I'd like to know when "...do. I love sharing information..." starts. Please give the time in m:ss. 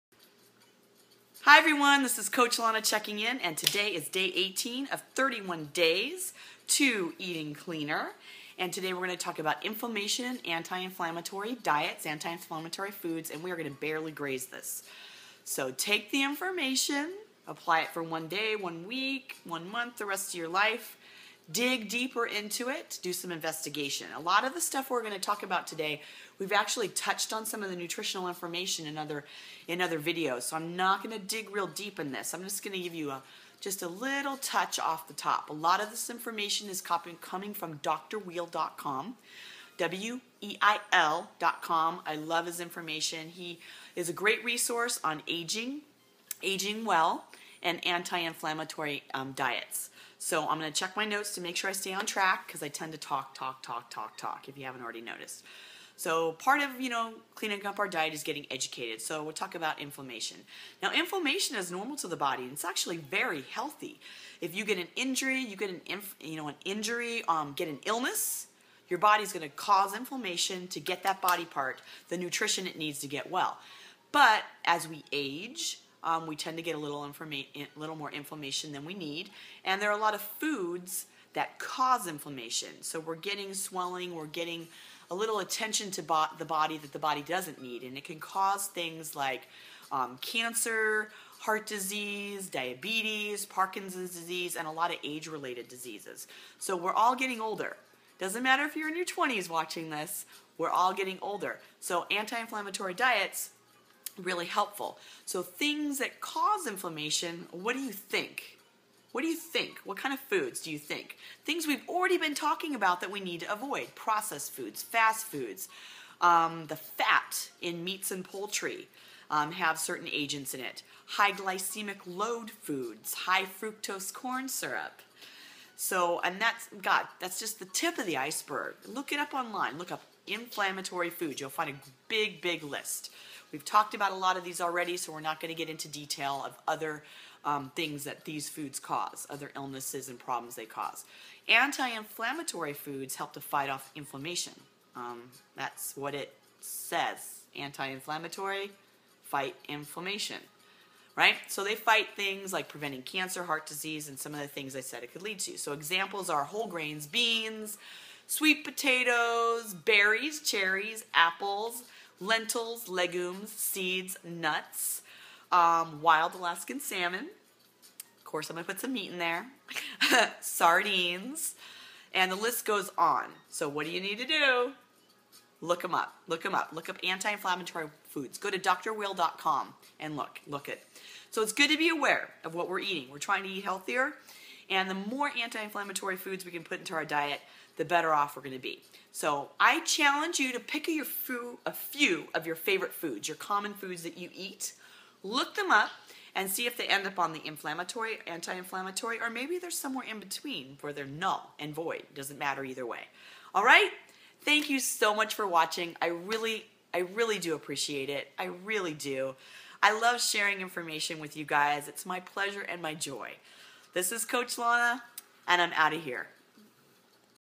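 3:28.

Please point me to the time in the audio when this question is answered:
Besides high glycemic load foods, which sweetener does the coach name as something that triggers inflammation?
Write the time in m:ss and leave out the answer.
2:03.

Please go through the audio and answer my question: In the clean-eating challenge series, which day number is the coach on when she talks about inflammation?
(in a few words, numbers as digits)
18.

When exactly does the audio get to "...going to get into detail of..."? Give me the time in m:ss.
2:15.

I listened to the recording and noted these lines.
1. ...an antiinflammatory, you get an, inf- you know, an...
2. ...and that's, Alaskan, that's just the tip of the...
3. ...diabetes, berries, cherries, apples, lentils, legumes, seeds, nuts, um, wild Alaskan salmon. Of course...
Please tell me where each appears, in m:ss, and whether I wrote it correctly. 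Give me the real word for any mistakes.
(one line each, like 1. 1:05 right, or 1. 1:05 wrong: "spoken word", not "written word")
1. 1:04 wrong: "injury", not "antiinflammatory"
2. 2:06 wrong: "God", not "Alaskan"
3. 2:38 wrong: "potatoes", not "diabetes".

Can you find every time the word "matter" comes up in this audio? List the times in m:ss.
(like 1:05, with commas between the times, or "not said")
1:38, 3:22.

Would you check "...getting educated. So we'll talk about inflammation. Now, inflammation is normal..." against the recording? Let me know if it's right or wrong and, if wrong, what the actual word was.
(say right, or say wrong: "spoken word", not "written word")
right.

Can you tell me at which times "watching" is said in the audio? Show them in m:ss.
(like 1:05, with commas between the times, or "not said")
1:39, 3:25.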